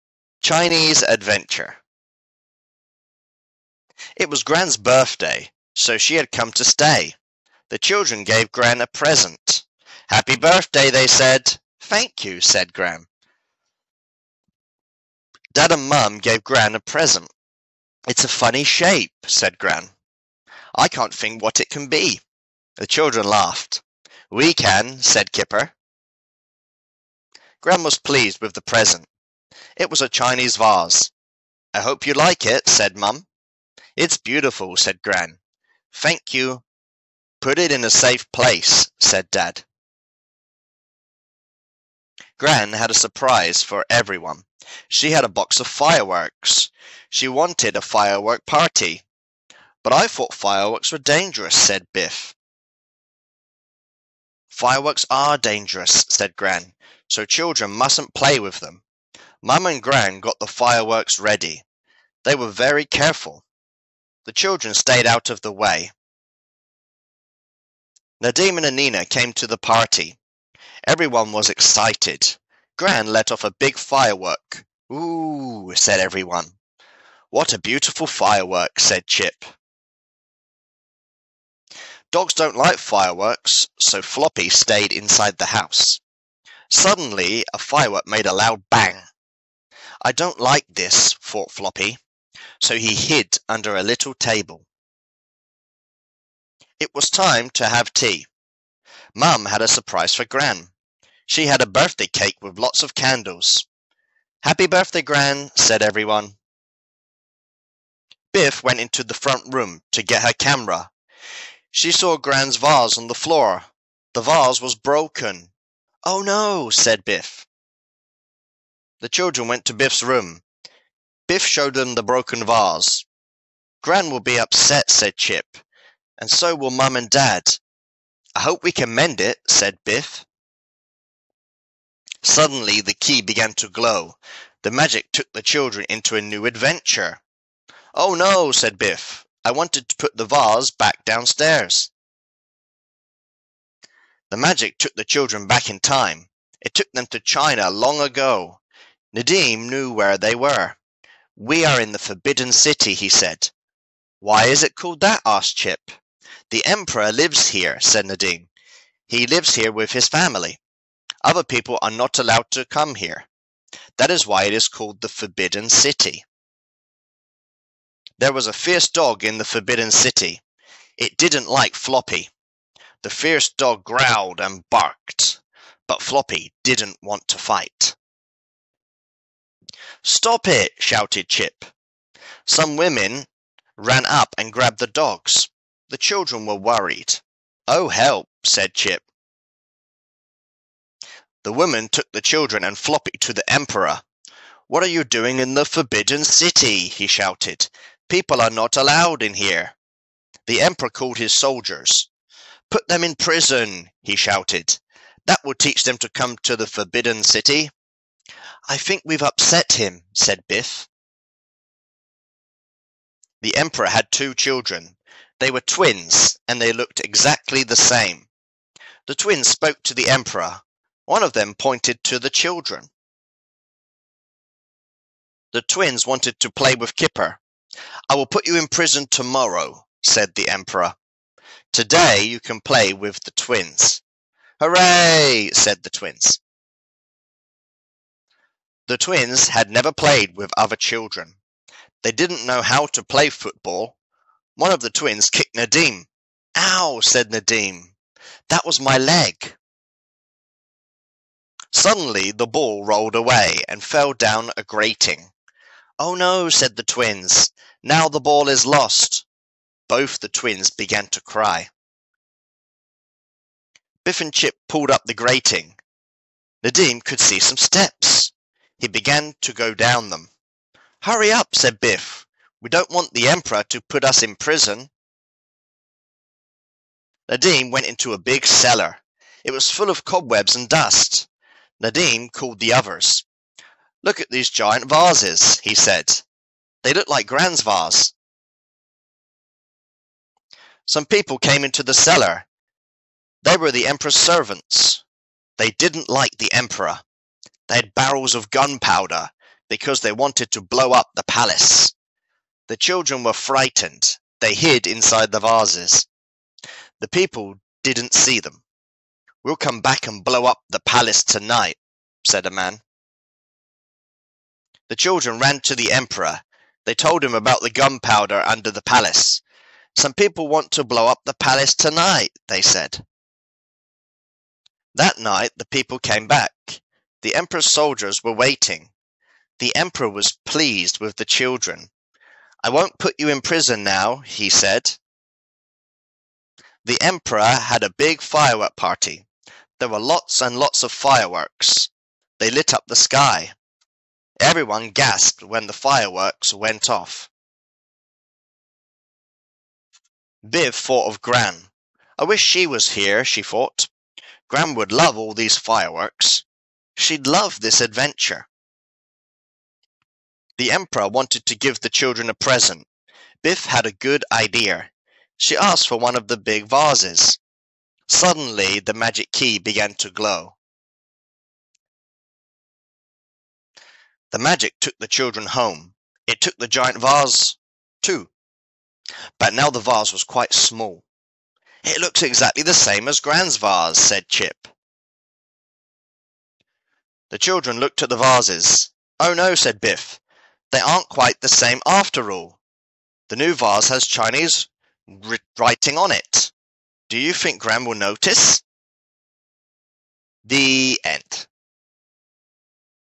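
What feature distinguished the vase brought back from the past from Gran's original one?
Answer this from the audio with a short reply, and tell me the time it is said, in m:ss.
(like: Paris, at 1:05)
Chinese writing, at 6:34.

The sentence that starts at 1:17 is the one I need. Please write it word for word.
What a beautiful firework, said Chip.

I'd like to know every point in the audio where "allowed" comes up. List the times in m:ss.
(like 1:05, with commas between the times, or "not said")
2:42, 3:18.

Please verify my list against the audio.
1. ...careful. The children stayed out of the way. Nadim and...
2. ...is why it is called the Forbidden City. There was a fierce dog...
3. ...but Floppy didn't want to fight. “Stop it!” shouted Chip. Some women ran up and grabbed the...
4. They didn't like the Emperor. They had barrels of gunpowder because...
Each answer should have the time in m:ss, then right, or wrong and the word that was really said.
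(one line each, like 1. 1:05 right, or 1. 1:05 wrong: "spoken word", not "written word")
1. 1:02 right
2. 2:44 right
3. 2:55 right
4. 4:55 right.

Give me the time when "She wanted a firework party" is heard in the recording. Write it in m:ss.
0:47.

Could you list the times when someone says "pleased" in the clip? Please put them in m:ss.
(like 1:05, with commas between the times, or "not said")
0:27, 5:30.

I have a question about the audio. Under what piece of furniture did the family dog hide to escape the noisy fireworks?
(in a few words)
a little table.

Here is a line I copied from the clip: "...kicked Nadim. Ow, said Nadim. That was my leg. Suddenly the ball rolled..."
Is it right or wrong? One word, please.
right.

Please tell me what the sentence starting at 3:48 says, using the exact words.
I will put you in prison tomorrow, said the emperor.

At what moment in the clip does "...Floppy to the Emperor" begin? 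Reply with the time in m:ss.
3:12.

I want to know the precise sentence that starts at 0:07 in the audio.
The children gave Gran a present.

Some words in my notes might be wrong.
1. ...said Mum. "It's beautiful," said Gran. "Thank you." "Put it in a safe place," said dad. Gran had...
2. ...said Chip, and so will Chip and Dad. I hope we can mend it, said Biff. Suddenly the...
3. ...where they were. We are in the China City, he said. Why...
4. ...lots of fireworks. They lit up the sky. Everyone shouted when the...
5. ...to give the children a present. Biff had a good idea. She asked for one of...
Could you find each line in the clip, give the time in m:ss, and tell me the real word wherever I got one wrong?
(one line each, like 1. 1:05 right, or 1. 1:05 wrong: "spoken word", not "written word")
1. 0:32 right
2. 2:04 wrong: "Mum", not "Chip"
3. 2:29 wrong: "Forbidden", not "China"
4. 5:40 wrong: "gasped", not "shouted"
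5. 6:01 right.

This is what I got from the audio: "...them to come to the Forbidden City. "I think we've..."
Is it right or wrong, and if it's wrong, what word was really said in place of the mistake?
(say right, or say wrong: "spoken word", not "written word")
right.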